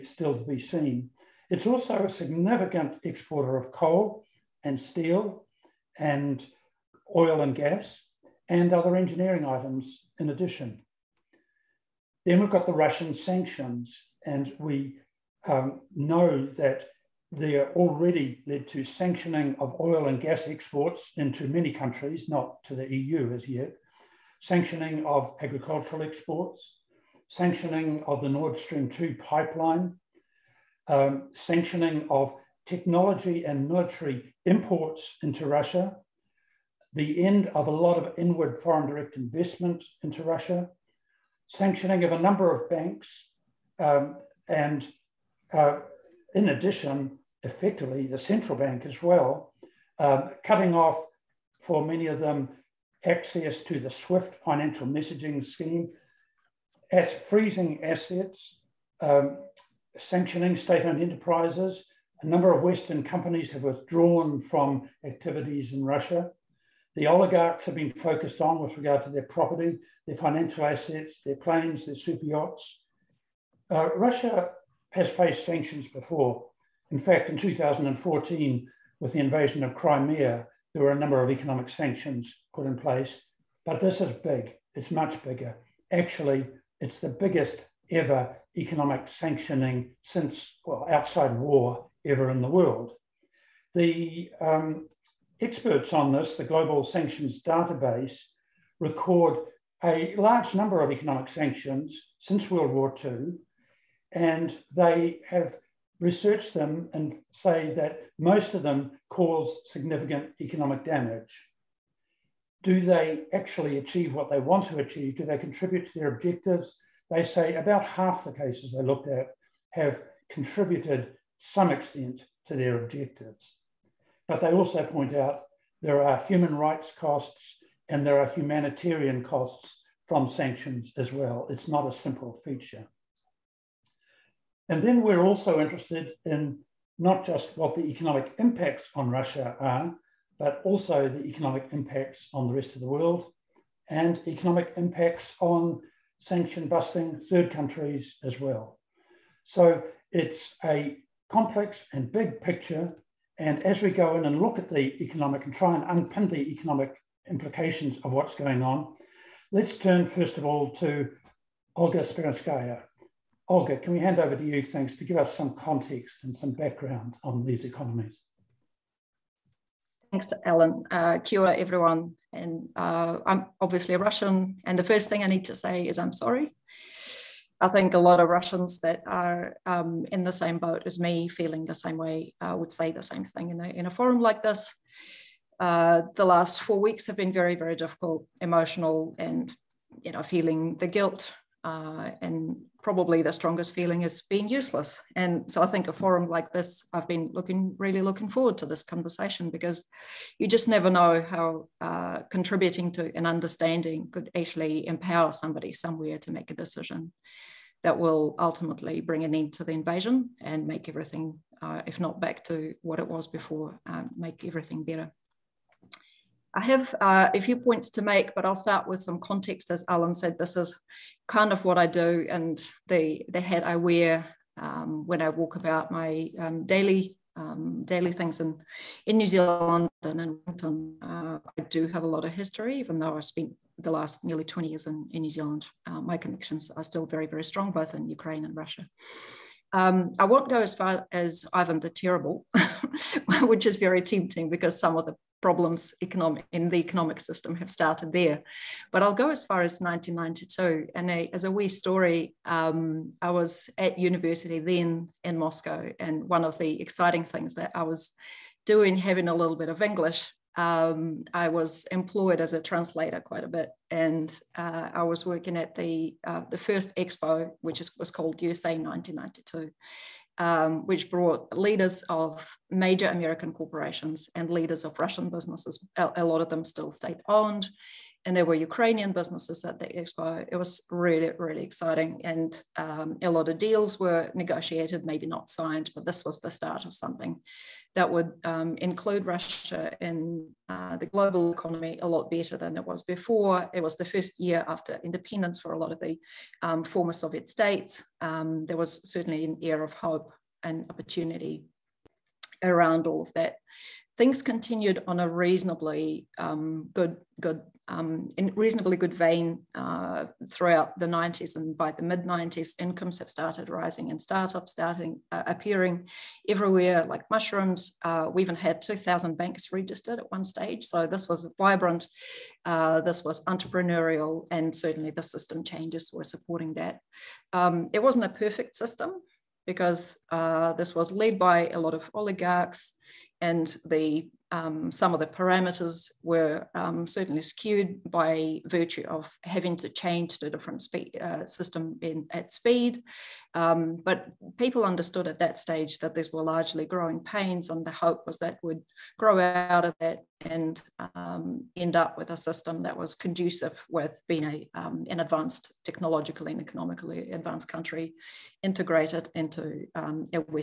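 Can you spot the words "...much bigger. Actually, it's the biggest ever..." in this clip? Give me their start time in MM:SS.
01:24.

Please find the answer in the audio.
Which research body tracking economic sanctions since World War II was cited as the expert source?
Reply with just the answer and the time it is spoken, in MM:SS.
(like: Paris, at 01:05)
Global Sanctions Database, at 01:36.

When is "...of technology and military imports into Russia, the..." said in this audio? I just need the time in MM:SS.
00:32.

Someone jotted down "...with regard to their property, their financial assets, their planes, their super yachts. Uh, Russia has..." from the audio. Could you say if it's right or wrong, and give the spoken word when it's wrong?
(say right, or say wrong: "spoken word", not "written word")
right.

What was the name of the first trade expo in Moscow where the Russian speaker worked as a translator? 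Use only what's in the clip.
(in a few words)
USA 1992.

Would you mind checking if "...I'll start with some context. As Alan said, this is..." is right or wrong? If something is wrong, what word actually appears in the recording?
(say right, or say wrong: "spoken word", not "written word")
right.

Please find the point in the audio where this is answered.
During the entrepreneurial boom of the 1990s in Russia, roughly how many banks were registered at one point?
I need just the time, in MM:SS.
05:18.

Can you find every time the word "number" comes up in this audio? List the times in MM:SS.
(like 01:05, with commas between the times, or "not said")
00:42, 01:02, 01:20, 01:40.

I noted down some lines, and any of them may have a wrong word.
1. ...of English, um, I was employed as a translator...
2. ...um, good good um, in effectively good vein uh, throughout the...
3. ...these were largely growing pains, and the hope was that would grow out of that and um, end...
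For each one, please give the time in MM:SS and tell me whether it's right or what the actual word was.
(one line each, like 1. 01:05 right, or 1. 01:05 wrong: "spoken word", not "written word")
1. 04:19 right
2. 05:06 wrong: "reasonably", not "effectively"
3. 05:46 right.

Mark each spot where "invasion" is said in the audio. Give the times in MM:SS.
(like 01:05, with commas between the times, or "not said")
01:19, 03:29.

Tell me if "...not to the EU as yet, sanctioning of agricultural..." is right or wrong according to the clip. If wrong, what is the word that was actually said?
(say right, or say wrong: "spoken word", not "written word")
right.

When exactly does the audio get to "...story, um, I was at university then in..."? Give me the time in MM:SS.
04:11.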